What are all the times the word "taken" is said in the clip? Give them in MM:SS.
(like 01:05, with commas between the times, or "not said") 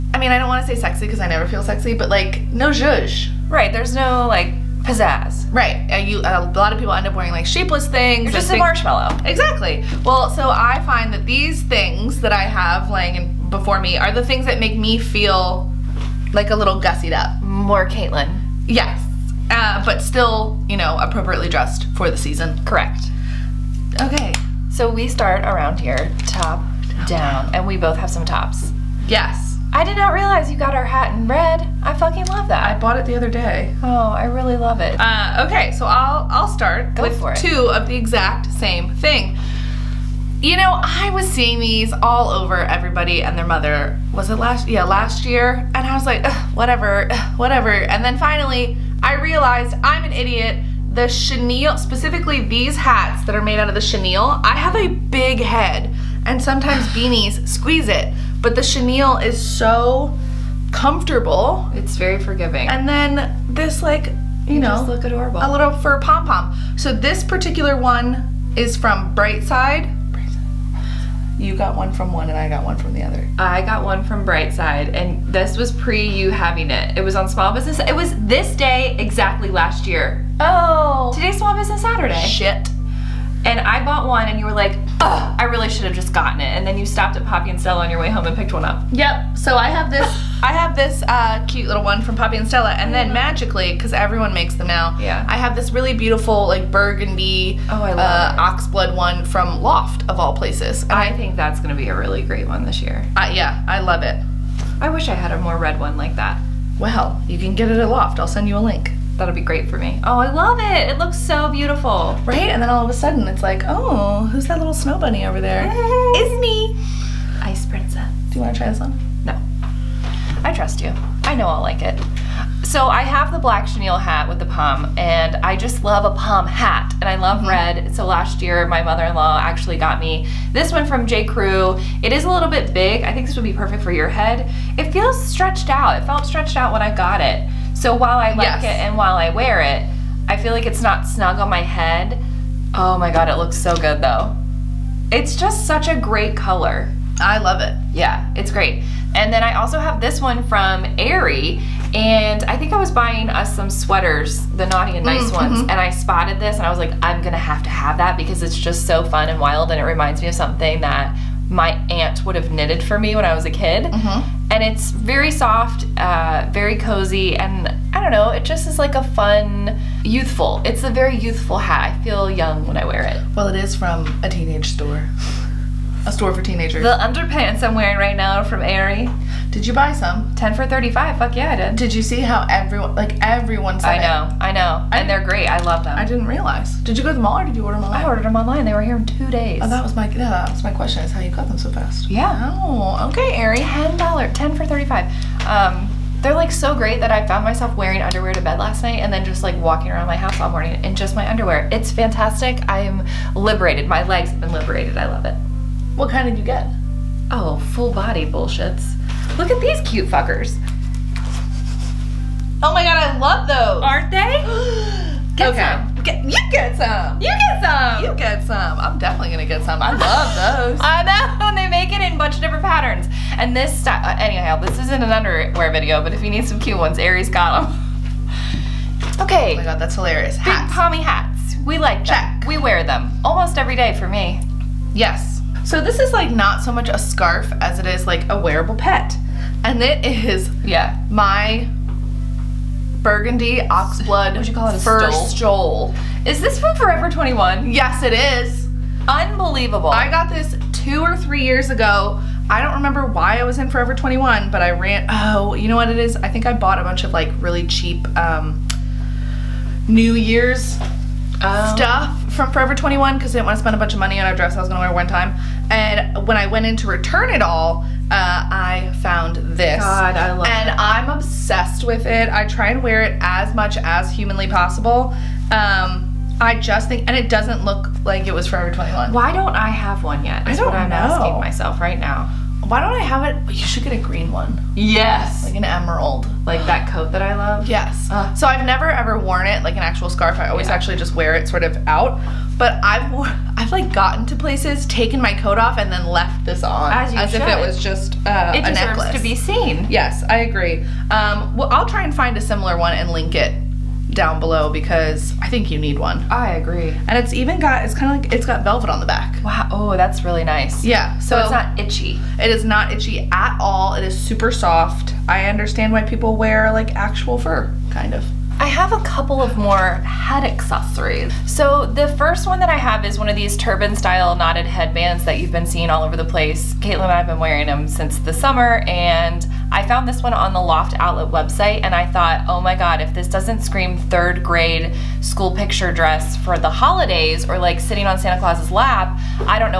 04:54.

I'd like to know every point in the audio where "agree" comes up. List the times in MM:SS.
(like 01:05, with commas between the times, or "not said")
05:00, 05:06.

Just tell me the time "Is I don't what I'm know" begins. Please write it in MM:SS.
04:40.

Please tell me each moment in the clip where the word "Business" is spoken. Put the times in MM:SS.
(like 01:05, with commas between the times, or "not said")
01:17, 01:21.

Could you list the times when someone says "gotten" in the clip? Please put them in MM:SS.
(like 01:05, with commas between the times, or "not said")
01:26, 04:53.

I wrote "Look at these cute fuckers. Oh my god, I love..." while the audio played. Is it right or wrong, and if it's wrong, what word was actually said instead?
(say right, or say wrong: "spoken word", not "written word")
right.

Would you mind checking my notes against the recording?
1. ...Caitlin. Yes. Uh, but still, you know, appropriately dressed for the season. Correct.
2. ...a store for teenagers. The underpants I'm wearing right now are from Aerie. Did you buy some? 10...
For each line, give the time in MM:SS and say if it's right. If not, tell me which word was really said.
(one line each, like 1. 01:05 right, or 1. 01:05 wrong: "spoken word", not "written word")
1. 00:17 right
2. 02:56 right.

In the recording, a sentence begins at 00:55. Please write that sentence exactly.
big head and sometimes beanies squeeze it.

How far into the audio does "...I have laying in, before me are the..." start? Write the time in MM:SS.
00:12.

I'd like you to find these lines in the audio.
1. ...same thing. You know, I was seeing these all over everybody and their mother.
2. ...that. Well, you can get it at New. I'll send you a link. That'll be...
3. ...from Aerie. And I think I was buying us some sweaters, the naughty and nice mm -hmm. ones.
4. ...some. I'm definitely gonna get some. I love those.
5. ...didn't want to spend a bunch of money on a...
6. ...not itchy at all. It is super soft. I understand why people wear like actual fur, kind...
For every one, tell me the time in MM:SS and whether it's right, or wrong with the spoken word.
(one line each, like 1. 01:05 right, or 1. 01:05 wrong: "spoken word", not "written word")
1. 00:38 right
2. 01:46 wrong: "Loft", not "New"
3. 02:30 right
4. 03:38 right
5. 04:23 right
6. 05:12 right.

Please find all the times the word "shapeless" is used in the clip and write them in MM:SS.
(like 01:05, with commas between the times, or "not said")
00:07.